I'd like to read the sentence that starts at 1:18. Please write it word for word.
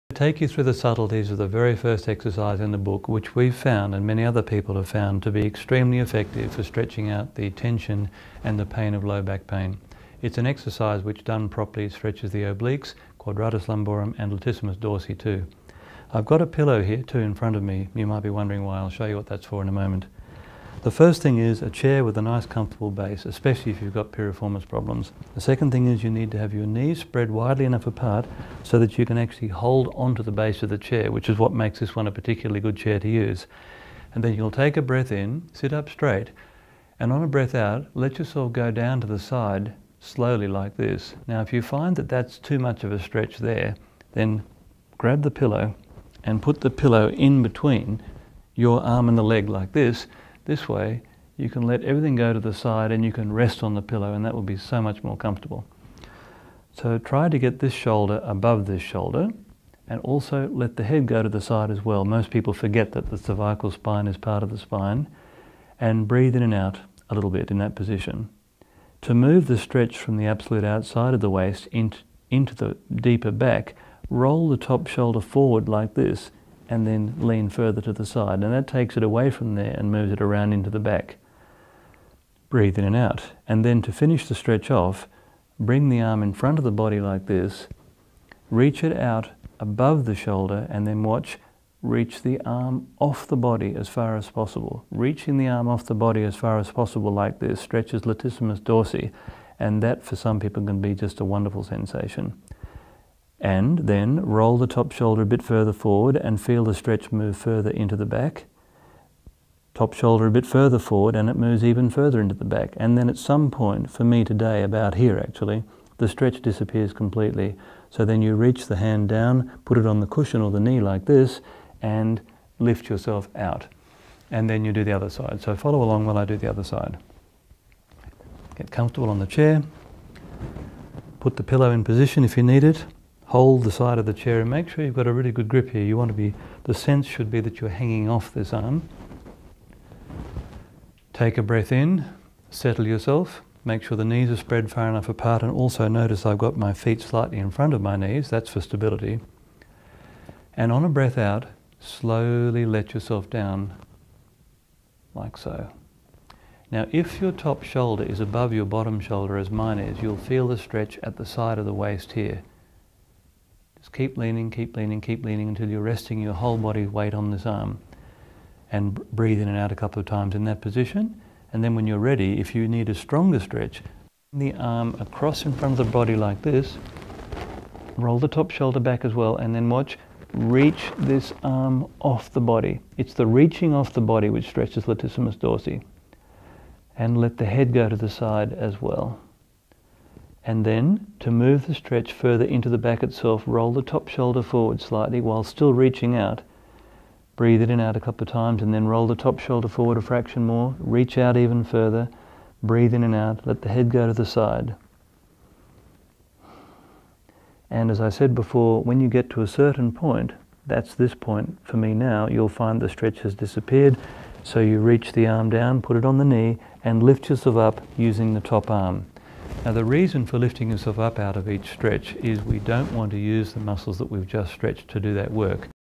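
And that takes it away from there and moves it around into the back.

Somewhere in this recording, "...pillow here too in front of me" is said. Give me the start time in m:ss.
0:16.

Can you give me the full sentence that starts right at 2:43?
Just keep leaning, keep leaning, keep leaning until you're resting your whole body weight on this arm.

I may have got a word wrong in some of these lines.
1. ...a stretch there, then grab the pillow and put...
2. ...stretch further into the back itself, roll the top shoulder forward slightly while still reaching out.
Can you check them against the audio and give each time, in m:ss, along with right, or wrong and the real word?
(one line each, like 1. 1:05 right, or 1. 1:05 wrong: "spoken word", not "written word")
1. 0:42 right
2. 3:11 right.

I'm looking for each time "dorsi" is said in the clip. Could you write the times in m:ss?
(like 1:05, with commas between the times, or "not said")
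0:14, 1:38, 3:05.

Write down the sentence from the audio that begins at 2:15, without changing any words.
You want to be, the sense should be that you're hanging off this arm.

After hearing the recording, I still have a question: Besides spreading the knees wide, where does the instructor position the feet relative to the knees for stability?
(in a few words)
Slightly in front.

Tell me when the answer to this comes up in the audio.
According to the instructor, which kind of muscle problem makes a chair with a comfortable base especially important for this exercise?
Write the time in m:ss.
0:24.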